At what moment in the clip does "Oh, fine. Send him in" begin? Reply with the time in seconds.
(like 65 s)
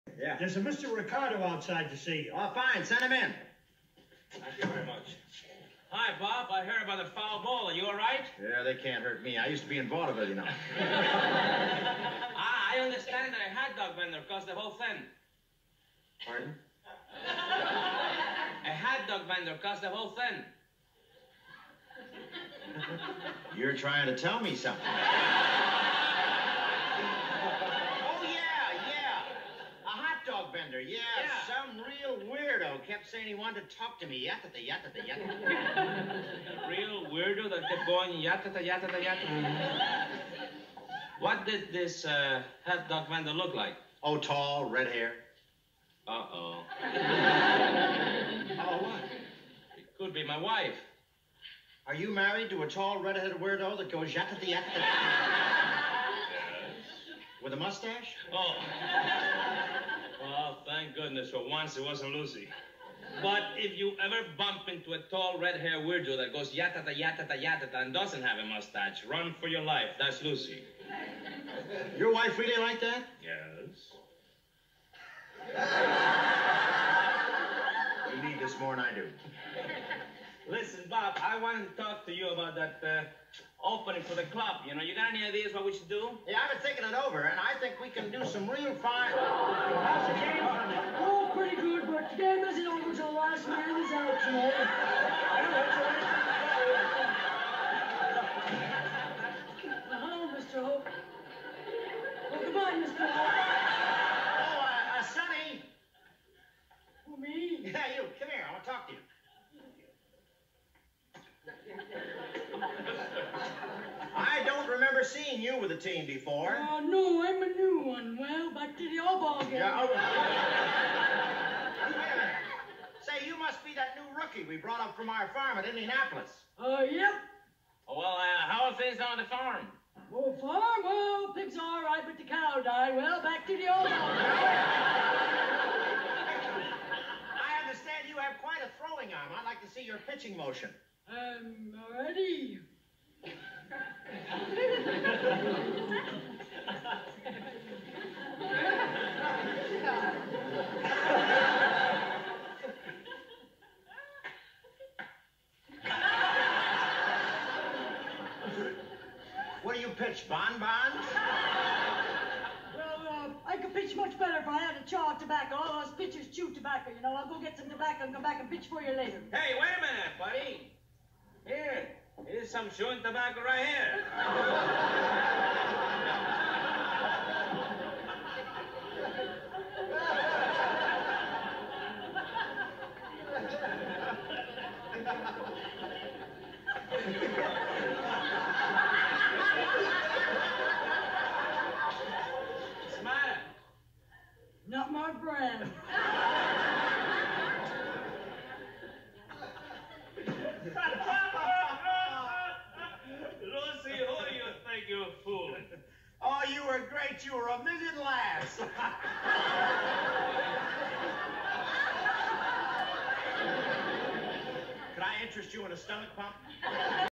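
2 s.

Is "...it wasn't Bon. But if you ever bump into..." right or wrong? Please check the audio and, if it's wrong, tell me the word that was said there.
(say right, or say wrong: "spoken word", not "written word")
wrong: "Lucy", not "Bon".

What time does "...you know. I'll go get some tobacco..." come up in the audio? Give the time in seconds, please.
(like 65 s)
166 s.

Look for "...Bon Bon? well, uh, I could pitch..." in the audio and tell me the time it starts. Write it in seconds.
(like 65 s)
160 s.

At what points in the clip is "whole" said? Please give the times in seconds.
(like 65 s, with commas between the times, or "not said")
14 s, 19 s.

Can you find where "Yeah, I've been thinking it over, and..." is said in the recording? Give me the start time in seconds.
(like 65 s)
86 s.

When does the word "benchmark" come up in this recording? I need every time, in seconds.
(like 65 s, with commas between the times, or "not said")
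not said.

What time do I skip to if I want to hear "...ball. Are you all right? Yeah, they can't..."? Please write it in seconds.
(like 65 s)
7 s.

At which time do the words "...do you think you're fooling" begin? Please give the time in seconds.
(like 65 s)
204 s.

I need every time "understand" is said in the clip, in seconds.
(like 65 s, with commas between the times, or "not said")
12 s, 137 s.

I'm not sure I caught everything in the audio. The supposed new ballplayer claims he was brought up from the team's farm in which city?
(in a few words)
Indianapolis.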